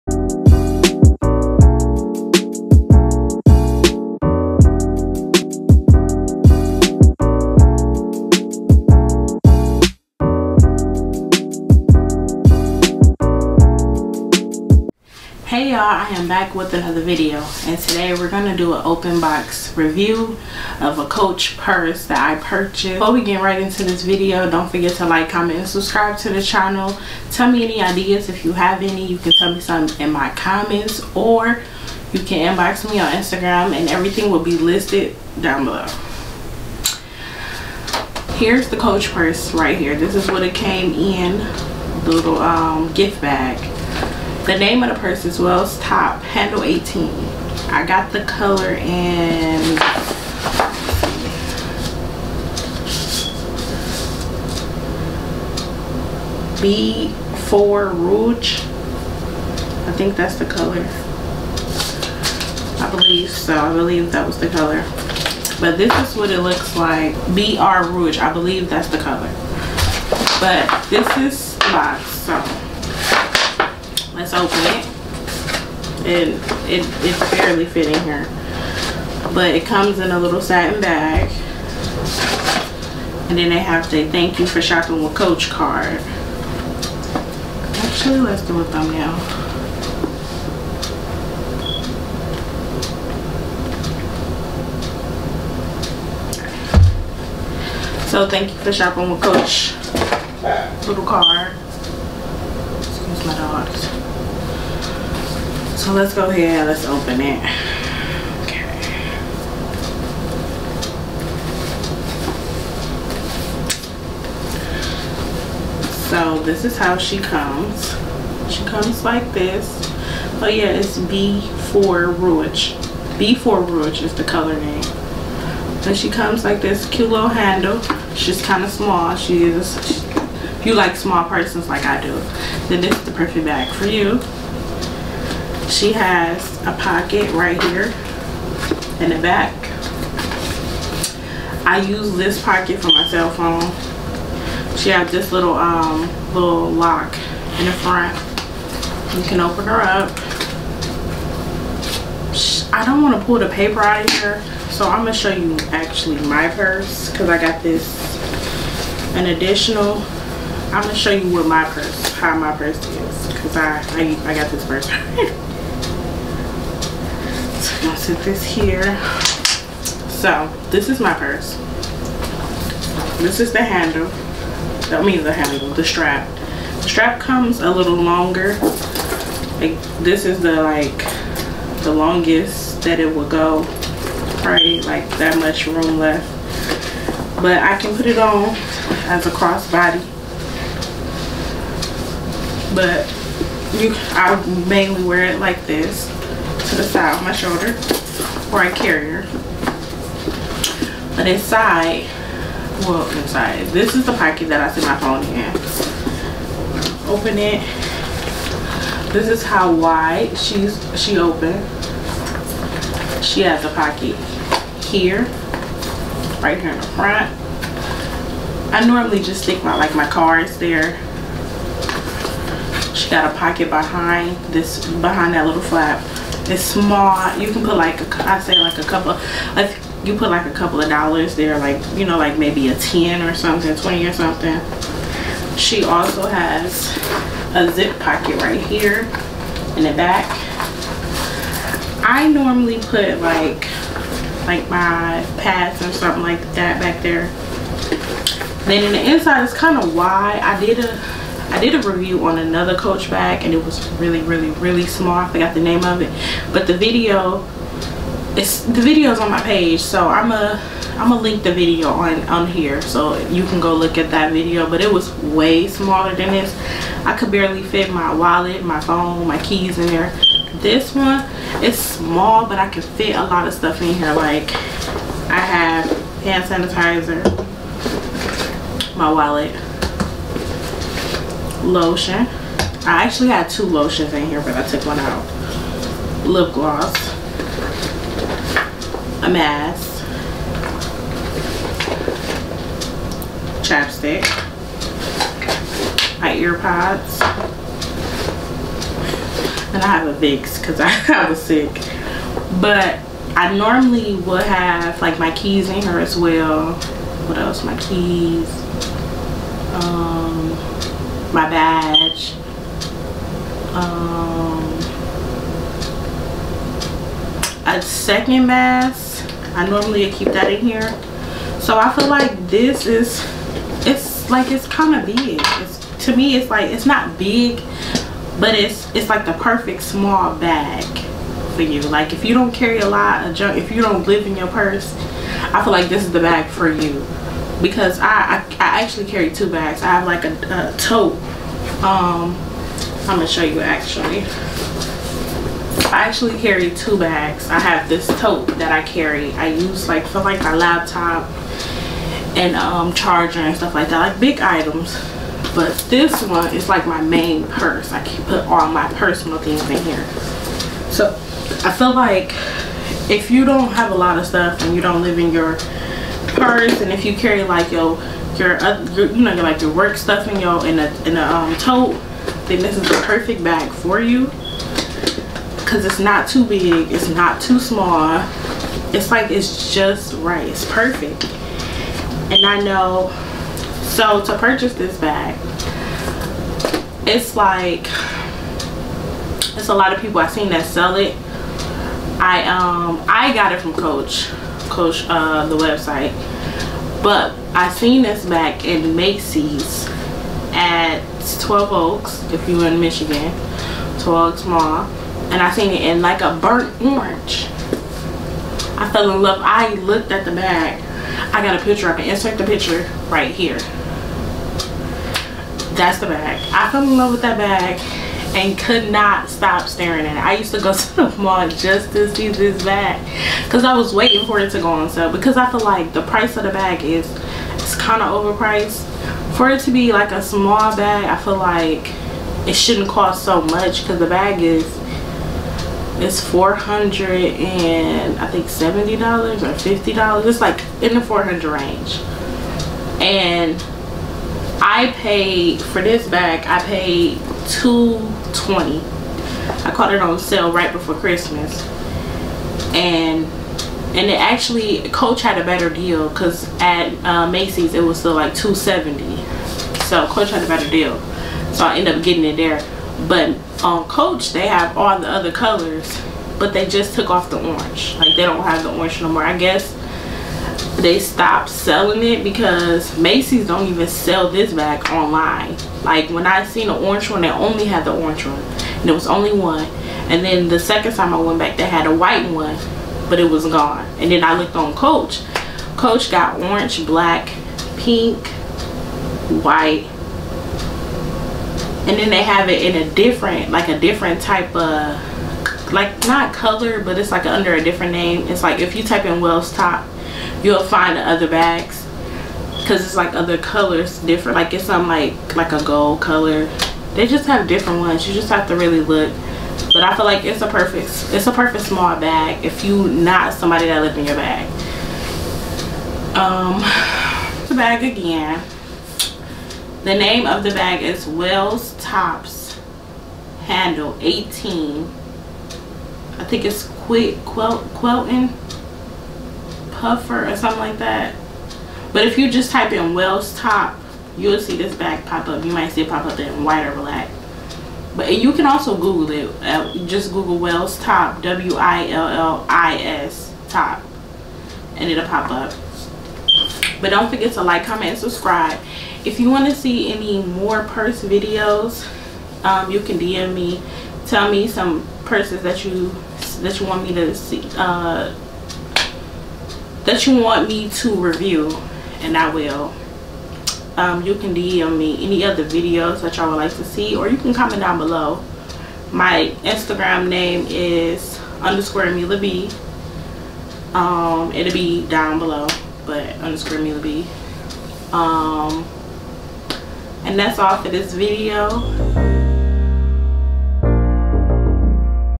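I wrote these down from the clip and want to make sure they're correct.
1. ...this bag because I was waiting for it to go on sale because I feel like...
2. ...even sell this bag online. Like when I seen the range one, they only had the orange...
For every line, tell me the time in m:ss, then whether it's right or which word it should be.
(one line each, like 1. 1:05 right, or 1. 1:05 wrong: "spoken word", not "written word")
1. 7:02 right
2. 7:53 wrong: "orange", not "range".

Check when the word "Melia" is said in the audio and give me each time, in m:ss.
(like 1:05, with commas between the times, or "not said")
9:31, 9:36.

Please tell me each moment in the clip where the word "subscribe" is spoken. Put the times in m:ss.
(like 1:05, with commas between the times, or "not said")
0:25, 9:07.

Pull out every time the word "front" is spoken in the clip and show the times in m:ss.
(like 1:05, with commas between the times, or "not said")
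2:27, 3:36.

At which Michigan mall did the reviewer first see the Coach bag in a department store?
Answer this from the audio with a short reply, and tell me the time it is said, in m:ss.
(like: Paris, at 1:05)
12 Oaks Mall, at 6:43.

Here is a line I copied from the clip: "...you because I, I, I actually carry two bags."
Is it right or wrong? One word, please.
right.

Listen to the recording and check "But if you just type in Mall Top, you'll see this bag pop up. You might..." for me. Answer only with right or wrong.
wrong.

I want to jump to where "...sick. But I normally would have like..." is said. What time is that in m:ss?
5:01.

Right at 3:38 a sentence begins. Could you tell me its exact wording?
I normally just stick my like my cards there.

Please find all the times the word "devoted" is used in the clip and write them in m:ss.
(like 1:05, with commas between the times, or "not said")
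not said.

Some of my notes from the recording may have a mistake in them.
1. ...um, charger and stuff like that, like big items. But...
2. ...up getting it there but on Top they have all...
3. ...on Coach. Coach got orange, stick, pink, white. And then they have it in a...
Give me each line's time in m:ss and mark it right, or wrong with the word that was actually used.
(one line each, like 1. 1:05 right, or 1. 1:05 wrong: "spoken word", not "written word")
1. 5:52 right
2. 7:41 wrong: "Coach", not "Top"
3. 8:04 wrong: "black", not "stick".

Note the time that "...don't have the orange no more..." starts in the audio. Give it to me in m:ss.
7:48.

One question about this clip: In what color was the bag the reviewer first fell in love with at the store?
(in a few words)
burnt orange.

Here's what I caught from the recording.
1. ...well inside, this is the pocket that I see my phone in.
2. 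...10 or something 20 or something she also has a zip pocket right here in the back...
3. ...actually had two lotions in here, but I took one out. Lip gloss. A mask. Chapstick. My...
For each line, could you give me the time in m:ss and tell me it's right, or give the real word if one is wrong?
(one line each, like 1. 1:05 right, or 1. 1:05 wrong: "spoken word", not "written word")
1. 3:22 right
2. 3:52 right
3. 4:43 right.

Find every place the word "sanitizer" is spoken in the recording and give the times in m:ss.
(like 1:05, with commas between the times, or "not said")
4:36.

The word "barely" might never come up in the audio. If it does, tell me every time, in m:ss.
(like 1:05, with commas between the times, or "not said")
1:17, 4:27.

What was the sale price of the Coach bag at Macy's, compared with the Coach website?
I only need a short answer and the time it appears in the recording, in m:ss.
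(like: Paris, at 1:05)
$270, at 7:38.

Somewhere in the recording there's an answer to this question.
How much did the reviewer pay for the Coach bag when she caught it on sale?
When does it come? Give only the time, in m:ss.
7:27.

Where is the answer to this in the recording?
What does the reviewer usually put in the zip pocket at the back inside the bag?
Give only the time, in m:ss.
4:04.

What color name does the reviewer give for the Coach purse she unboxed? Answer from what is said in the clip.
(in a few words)
B4 Rouge.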